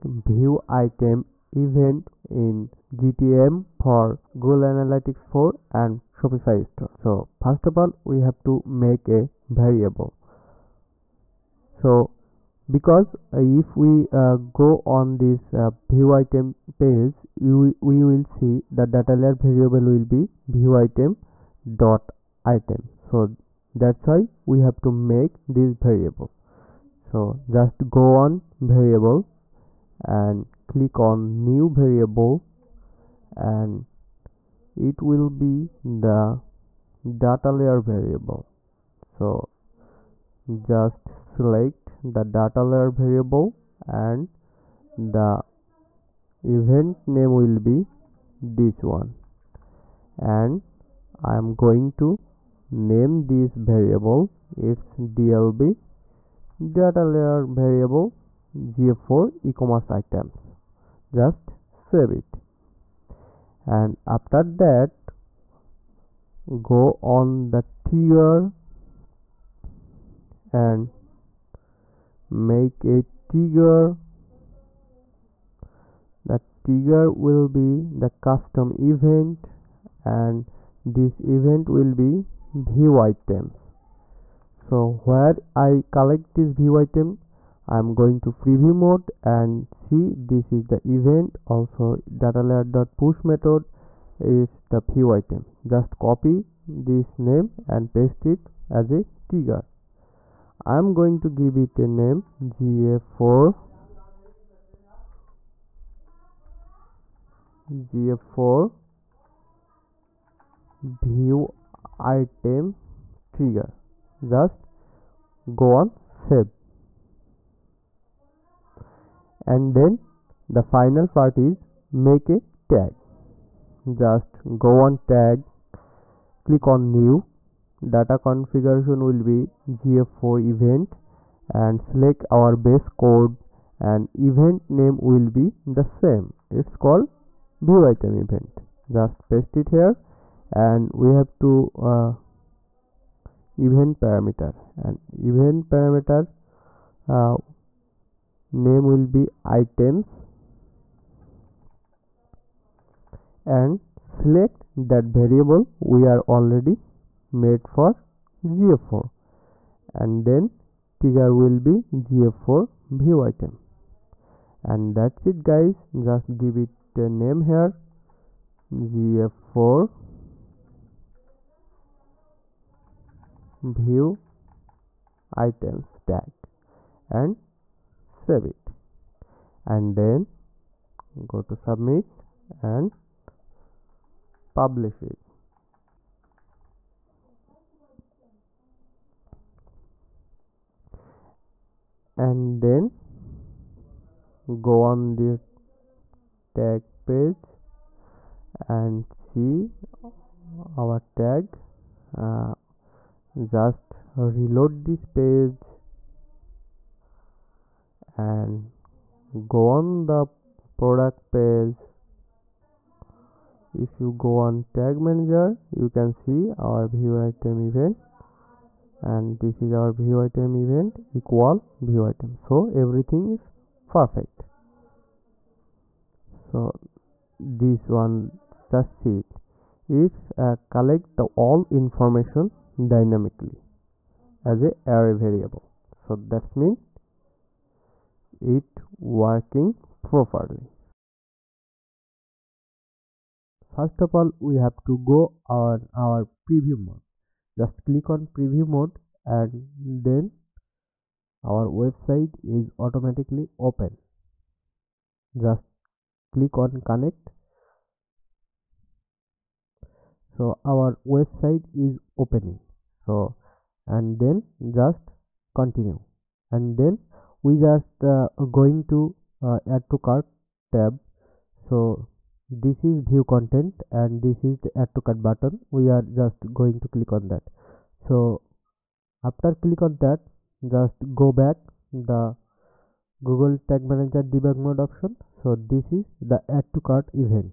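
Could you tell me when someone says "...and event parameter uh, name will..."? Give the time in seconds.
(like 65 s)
144 s.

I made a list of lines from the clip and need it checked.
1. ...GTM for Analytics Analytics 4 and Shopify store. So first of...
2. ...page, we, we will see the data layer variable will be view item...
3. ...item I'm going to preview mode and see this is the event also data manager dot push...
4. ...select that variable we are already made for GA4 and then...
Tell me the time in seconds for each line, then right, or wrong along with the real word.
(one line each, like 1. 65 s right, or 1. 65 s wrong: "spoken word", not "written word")
1. 2 s wrong: "Google", not "Analytics"
2. 16 s right
3. 86 s wrong: "layer", not "manager"
4. 153 s right.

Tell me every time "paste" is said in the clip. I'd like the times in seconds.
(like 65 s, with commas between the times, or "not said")
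97 s, 139 s.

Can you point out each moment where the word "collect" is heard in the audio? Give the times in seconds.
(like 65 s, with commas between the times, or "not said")
85 s, 230 s.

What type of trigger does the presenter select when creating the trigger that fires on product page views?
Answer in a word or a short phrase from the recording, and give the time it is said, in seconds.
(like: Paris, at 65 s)
Custom event, at 78 s.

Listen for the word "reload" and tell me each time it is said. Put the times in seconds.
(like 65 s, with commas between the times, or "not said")
204 s.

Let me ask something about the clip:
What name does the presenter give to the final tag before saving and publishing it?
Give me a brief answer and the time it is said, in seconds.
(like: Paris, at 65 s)
GA4 view items tag, at 168 s.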